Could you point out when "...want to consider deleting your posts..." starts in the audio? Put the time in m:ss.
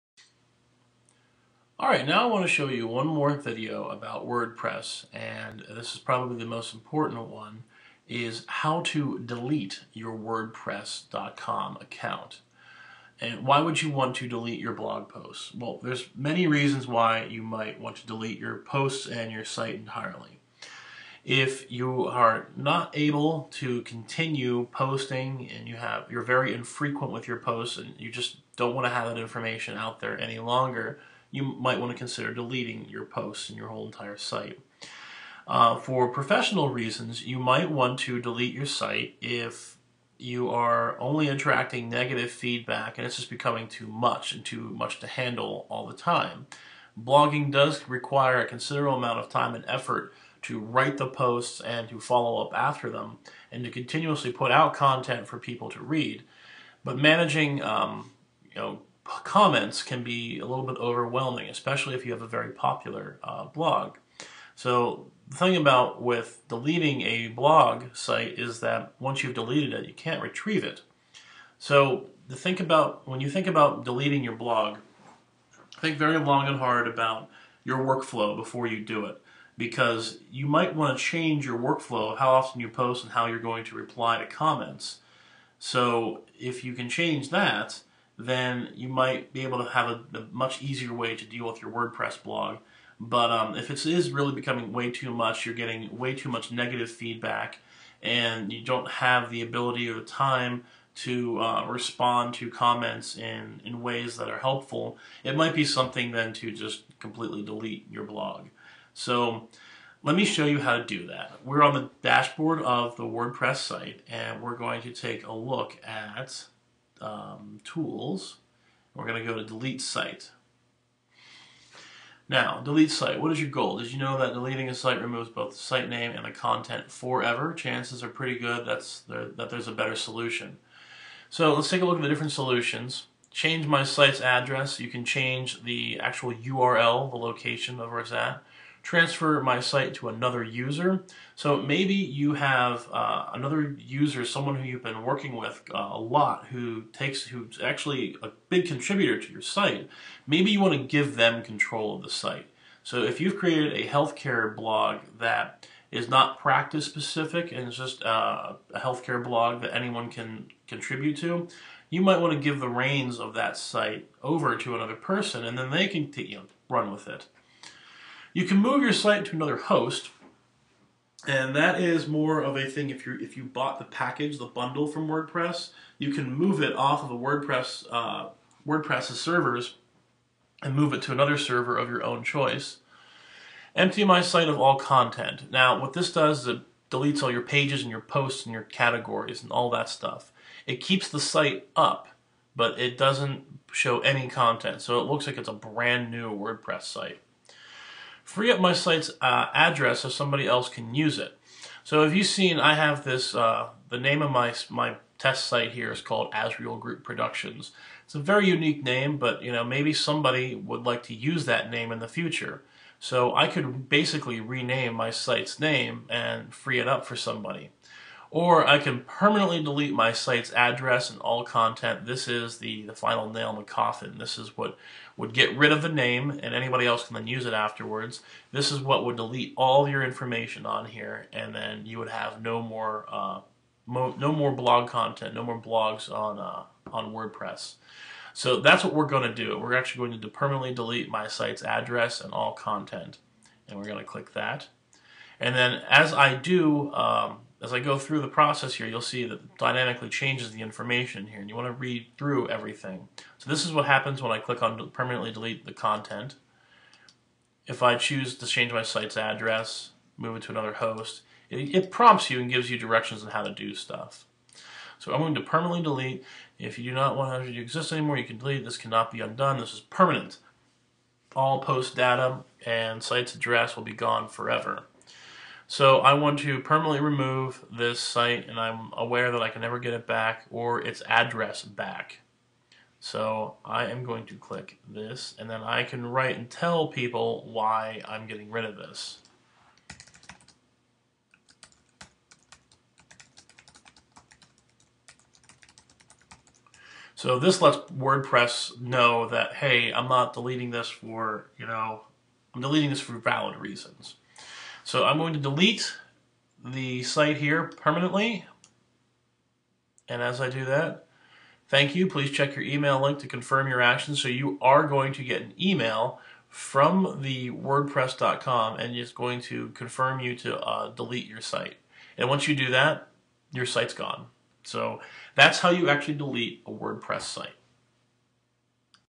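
0:31.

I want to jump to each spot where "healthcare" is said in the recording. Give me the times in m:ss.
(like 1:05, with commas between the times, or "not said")
2:33, 2:38.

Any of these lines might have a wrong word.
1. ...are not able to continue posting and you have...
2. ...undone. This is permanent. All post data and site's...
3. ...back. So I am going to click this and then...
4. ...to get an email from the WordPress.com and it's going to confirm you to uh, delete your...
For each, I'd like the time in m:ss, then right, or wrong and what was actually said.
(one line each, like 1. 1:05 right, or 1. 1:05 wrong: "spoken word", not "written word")
1. 0:22 right
2. 4:29 right
3. 4:41 right
4. 5:15 right.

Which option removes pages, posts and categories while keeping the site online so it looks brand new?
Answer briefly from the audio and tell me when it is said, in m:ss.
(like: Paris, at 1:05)
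Empty my site of all content, at 3:03.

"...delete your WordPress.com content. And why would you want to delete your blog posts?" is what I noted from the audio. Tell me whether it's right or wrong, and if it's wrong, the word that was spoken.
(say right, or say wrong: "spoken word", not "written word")
wrong: "account", not "content".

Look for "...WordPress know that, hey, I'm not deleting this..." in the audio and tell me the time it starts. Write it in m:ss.
4:57.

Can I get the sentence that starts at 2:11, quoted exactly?
So let's take a look at the different solutions.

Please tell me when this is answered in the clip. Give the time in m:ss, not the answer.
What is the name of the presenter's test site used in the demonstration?
3:26.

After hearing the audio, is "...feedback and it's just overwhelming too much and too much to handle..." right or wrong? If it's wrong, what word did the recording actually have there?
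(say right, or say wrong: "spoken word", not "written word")
wrong: "becoming", not "overwhelming".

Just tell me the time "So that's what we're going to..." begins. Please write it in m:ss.
3:58.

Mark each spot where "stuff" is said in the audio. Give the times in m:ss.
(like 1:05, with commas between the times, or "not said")
3:09, 4:23.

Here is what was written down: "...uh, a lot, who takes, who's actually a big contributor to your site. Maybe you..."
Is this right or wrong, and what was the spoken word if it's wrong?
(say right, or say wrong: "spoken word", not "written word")
right.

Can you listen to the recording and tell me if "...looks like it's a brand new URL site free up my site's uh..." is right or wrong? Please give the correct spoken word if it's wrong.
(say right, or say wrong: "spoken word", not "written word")
wrong: "WordPress", not "URL".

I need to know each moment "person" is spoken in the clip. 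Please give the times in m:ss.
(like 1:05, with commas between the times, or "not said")
2:44.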